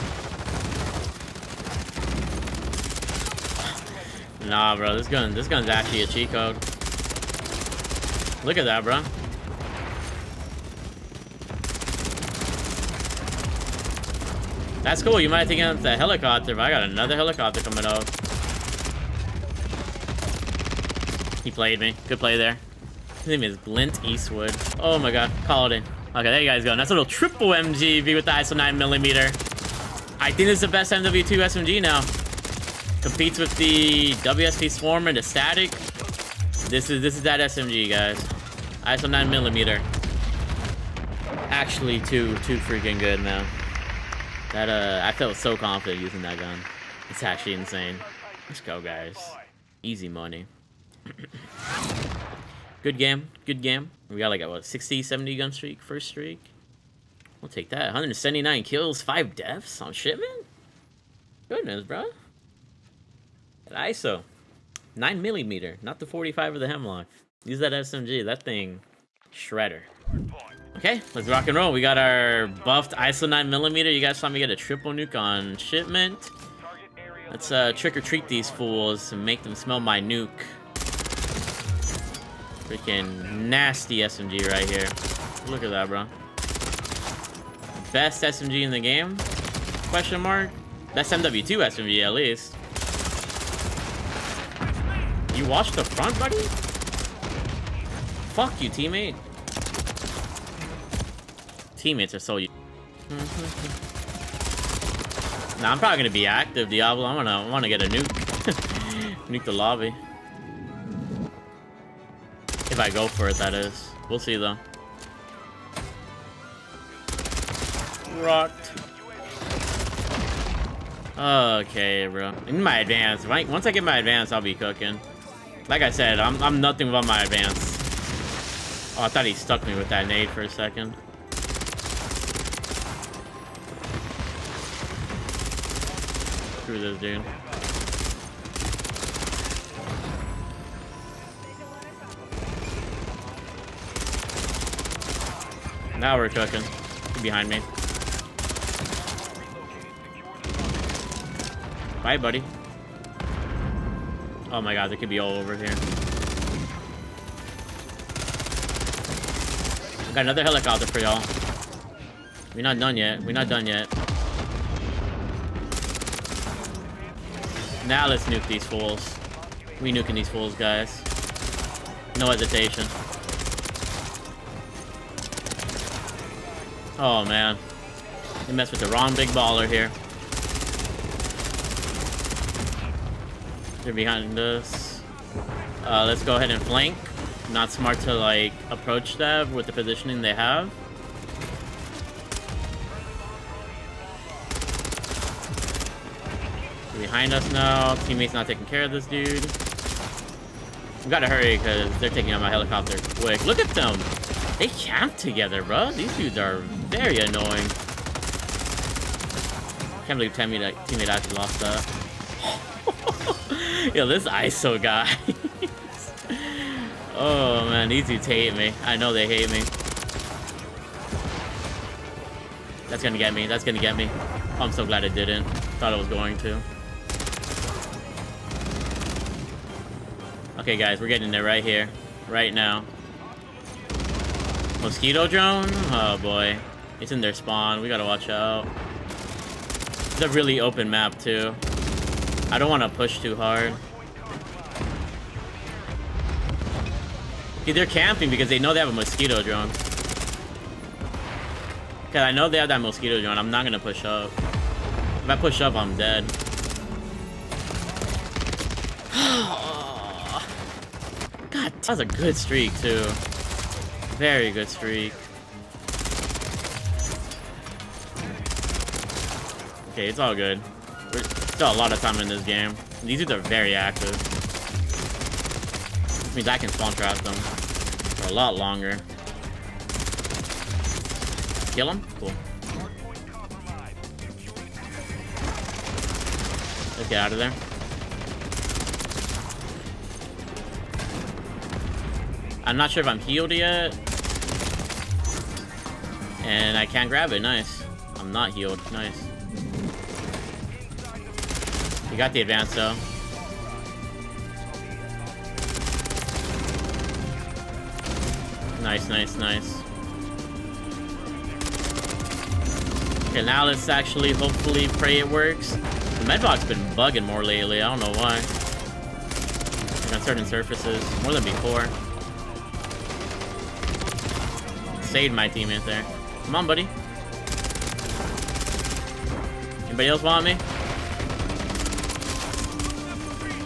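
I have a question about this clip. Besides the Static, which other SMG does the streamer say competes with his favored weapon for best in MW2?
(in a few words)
WSV.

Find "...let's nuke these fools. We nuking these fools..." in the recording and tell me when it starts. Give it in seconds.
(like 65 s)
168 s.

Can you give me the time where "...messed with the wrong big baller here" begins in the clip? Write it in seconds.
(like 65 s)
178 s.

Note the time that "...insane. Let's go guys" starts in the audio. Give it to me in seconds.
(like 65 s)
47 s.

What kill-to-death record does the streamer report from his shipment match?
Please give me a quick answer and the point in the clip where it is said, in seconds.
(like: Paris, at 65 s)
179 kills, 5 deaths, at 57 s.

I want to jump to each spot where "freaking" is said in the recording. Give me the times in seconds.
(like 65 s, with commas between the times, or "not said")
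42 s, 82 s.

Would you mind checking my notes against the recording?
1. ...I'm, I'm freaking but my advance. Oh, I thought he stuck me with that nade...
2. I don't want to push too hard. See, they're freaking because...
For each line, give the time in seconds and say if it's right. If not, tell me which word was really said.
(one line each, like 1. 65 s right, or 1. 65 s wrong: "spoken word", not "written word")
1. 126 s wrong: "nothing", not "freaking"
2. 242 s wrong: "camping", not "freaking".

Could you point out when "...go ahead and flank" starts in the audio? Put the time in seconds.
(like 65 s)
186 s.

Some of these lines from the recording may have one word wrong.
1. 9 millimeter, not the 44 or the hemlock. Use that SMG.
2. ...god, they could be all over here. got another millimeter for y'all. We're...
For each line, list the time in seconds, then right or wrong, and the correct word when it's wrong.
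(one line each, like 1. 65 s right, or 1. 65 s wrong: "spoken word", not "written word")
1. 64 s wrong: "45", not "44"
2. 154 s wrong: "helicopter", not "millimeter".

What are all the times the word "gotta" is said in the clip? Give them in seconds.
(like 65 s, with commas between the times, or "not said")
201 s, 237 s.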